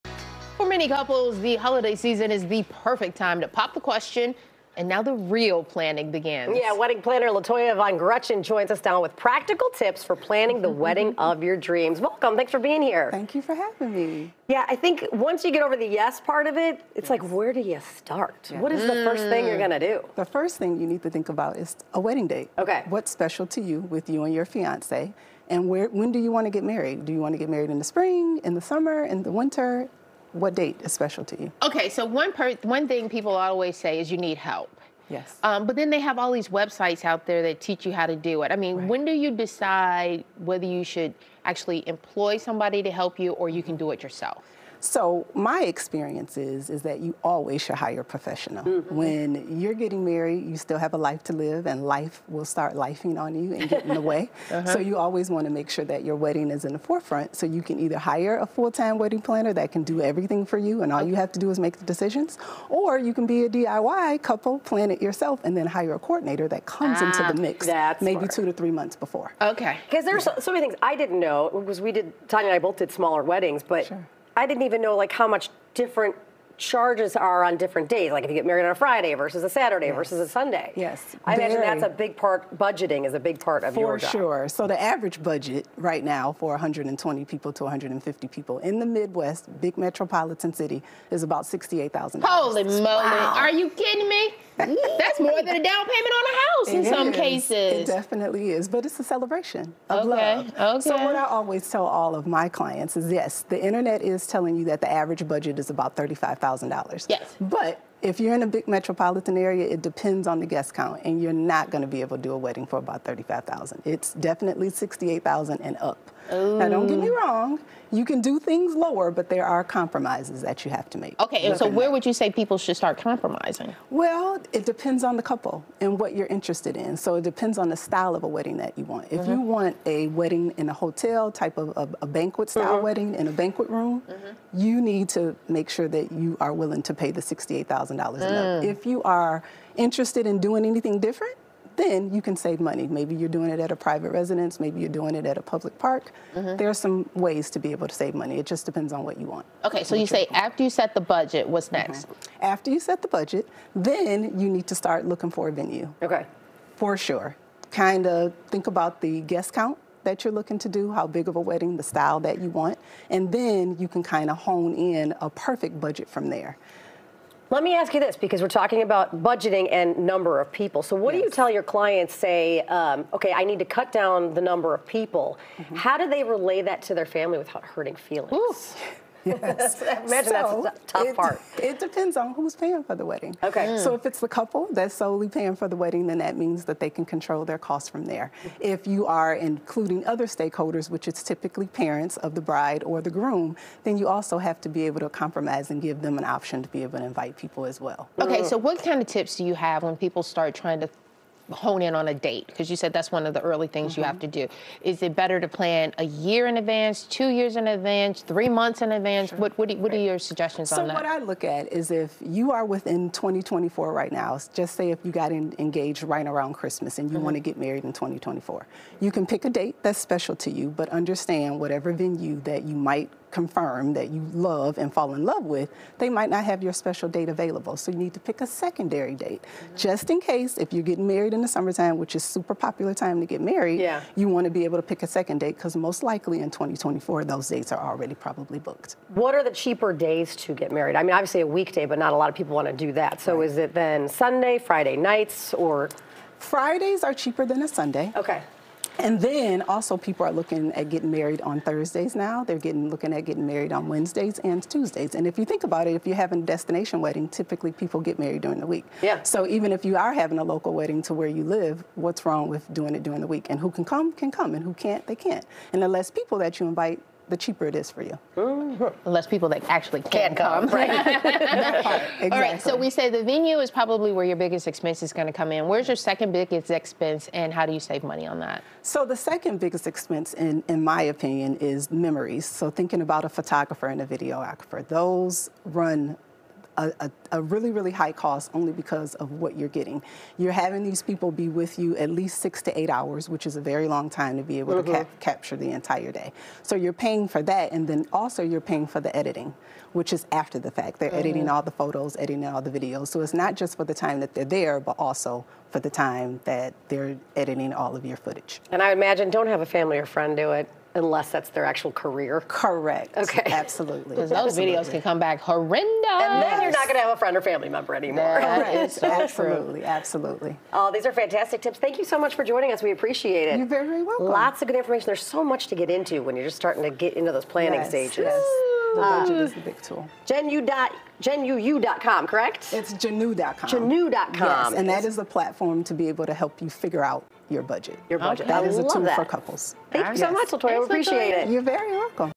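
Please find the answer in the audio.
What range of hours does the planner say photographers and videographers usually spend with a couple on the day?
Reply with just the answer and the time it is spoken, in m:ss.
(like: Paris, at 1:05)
6 to 8 hours, at 4:52.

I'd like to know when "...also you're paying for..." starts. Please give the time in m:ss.
4:58.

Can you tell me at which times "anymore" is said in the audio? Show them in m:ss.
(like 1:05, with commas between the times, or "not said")
5:17.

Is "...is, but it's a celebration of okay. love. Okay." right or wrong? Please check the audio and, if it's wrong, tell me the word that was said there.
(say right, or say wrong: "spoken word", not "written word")
right.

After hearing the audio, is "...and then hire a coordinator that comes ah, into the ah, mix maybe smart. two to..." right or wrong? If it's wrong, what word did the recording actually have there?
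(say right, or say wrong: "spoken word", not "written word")
right.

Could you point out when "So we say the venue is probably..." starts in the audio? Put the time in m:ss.
4:32.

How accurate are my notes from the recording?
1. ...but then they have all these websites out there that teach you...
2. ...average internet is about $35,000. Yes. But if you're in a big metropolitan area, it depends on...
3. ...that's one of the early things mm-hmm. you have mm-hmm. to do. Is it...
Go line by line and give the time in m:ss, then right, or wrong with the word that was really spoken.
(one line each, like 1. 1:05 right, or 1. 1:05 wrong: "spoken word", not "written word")
1. 0:35 right
2. 1:44 wrong: "budget", not "internet"
3. 3:22 right.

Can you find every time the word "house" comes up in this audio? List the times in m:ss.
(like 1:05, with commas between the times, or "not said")
1:36.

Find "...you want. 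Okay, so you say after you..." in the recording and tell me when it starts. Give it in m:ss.
2:29.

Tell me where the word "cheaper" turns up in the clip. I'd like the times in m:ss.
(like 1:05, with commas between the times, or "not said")
3:59, 4:07, 4:27.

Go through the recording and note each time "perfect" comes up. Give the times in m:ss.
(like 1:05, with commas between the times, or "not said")
0:02, 2:45.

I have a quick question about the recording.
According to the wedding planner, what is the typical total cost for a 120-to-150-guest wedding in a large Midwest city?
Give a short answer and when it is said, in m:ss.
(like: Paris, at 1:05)
$68,000, at 1:31.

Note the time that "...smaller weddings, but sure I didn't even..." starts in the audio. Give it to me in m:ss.
1:12.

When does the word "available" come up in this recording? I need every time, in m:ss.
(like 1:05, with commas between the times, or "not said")
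3:47.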